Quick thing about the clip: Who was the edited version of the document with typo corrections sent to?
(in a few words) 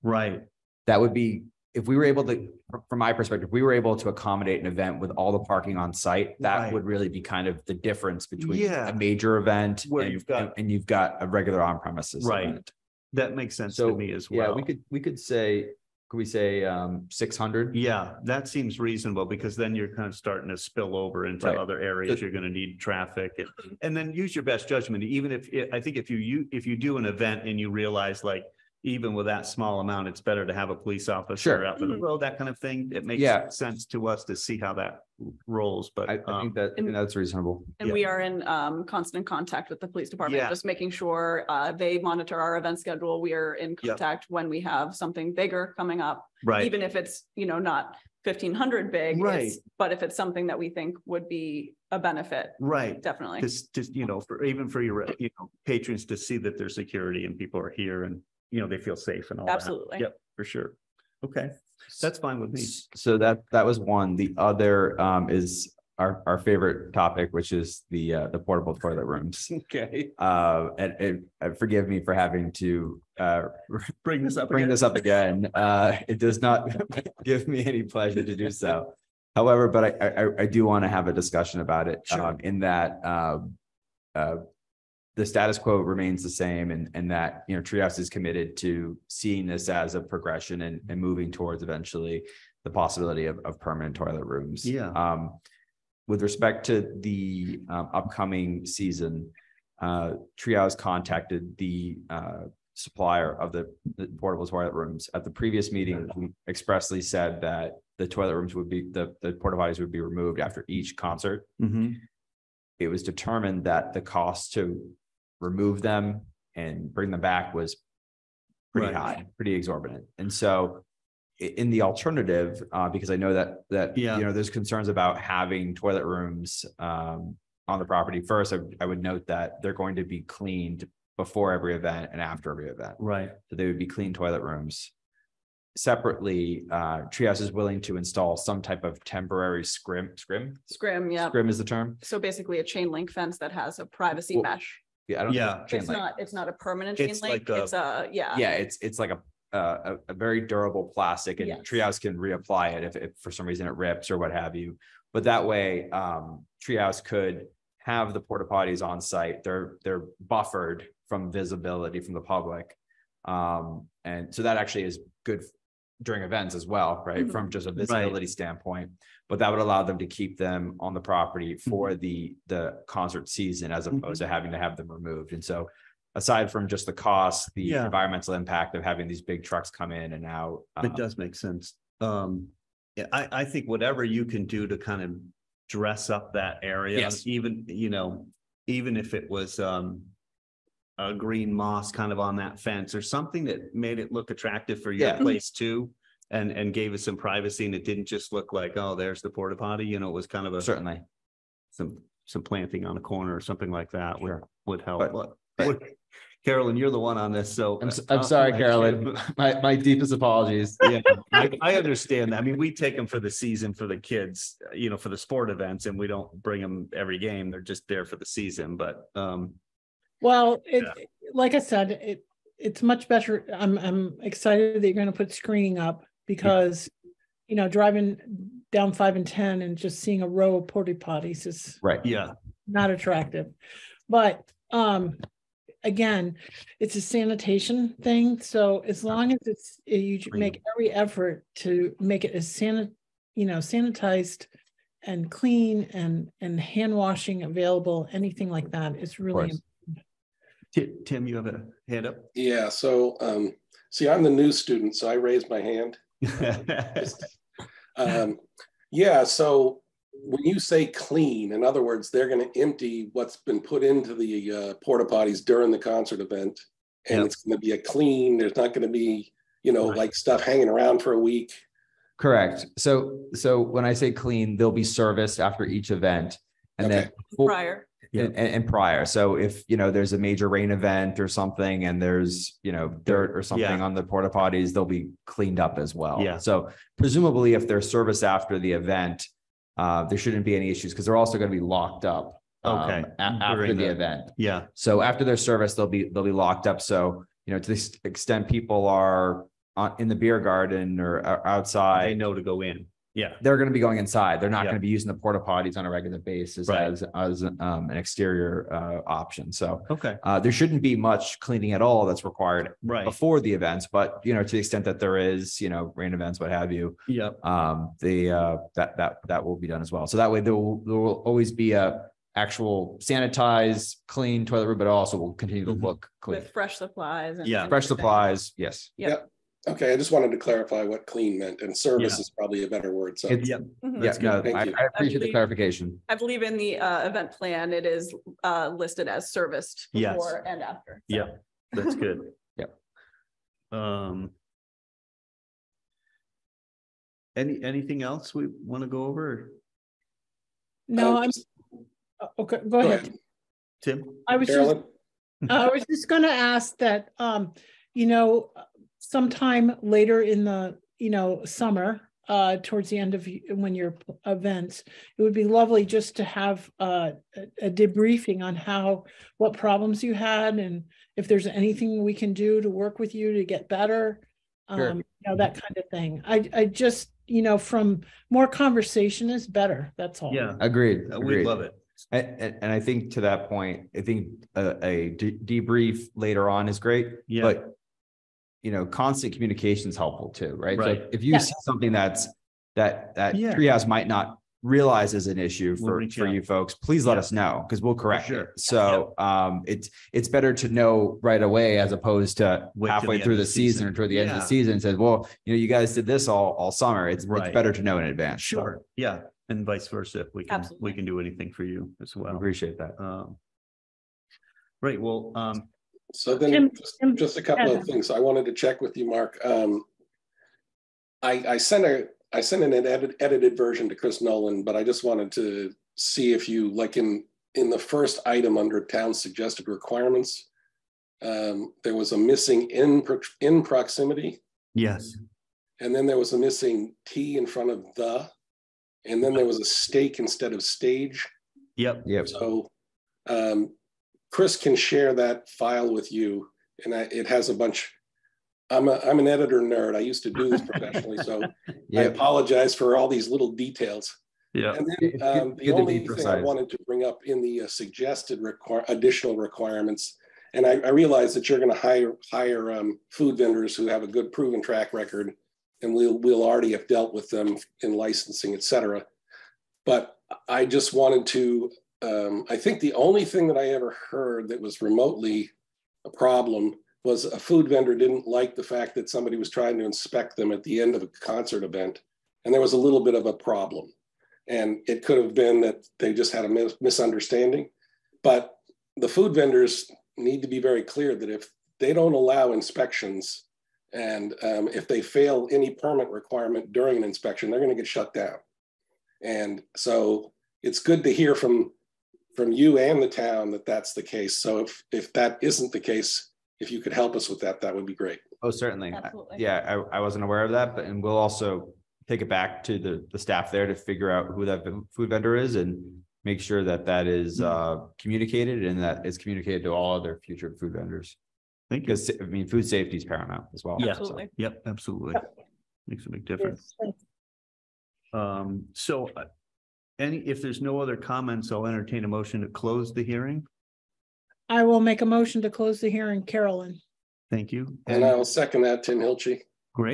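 Chris Nolan.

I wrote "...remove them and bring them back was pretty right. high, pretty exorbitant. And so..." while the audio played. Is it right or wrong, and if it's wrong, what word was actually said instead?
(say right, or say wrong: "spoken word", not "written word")
right.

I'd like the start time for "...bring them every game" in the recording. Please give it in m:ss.
3:36.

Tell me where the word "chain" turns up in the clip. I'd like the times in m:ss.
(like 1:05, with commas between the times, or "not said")
2:22, 2:26.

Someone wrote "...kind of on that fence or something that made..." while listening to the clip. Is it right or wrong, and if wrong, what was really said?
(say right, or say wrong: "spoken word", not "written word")
right.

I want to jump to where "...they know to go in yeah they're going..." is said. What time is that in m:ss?
5:02.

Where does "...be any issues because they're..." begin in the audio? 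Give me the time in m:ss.
4:50.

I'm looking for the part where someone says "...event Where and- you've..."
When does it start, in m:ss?
0:09.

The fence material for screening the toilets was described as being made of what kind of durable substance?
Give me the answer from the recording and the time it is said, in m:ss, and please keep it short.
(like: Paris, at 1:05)
plastic, at 2:30.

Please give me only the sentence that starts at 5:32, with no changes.
is probably a better word, so.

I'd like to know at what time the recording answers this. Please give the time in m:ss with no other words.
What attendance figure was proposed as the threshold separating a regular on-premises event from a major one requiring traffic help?
0:17.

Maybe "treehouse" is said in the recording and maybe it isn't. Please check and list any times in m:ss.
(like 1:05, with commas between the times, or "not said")
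1:27, 1:40, 2:17, 2:31, 2:36, 6:33.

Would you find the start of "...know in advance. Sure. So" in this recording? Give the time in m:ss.
6:47.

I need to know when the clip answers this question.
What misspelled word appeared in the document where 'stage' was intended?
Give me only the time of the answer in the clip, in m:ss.
7:19.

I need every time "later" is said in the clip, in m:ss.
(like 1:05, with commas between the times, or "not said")
5:59, 6:26.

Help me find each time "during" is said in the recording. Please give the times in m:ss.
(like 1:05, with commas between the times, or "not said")
2:46, 4:25, 8:16.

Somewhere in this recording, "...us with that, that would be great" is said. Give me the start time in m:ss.
8:27.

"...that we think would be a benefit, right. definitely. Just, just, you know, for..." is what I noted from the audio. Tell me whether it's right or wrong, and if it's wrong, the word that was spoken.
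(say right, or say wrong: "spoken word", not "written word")
right.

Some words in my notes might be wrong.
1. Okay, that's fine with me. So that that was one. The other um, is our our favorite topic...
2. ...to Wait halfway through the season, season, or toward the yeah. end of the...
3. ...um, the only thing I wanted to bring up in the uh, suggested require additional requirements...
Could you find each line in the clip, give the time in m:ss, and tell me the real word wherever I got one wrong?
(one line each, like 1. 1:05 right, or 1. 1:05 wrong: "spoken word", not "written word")
1. 1:01 right
2. 6:42 right
3. 7:35 right.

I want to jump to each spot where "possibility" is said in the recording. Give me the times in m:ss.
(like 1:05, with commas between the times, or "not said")
1:32.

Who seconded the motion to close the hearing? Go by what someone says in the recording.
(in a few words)
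Tim Hilchi.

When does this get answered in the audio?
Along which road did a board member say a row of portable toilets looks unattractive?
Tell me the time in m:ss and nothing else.
3:48.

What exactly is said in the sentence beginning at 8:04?
And it could have been that they just had a misunderstanding.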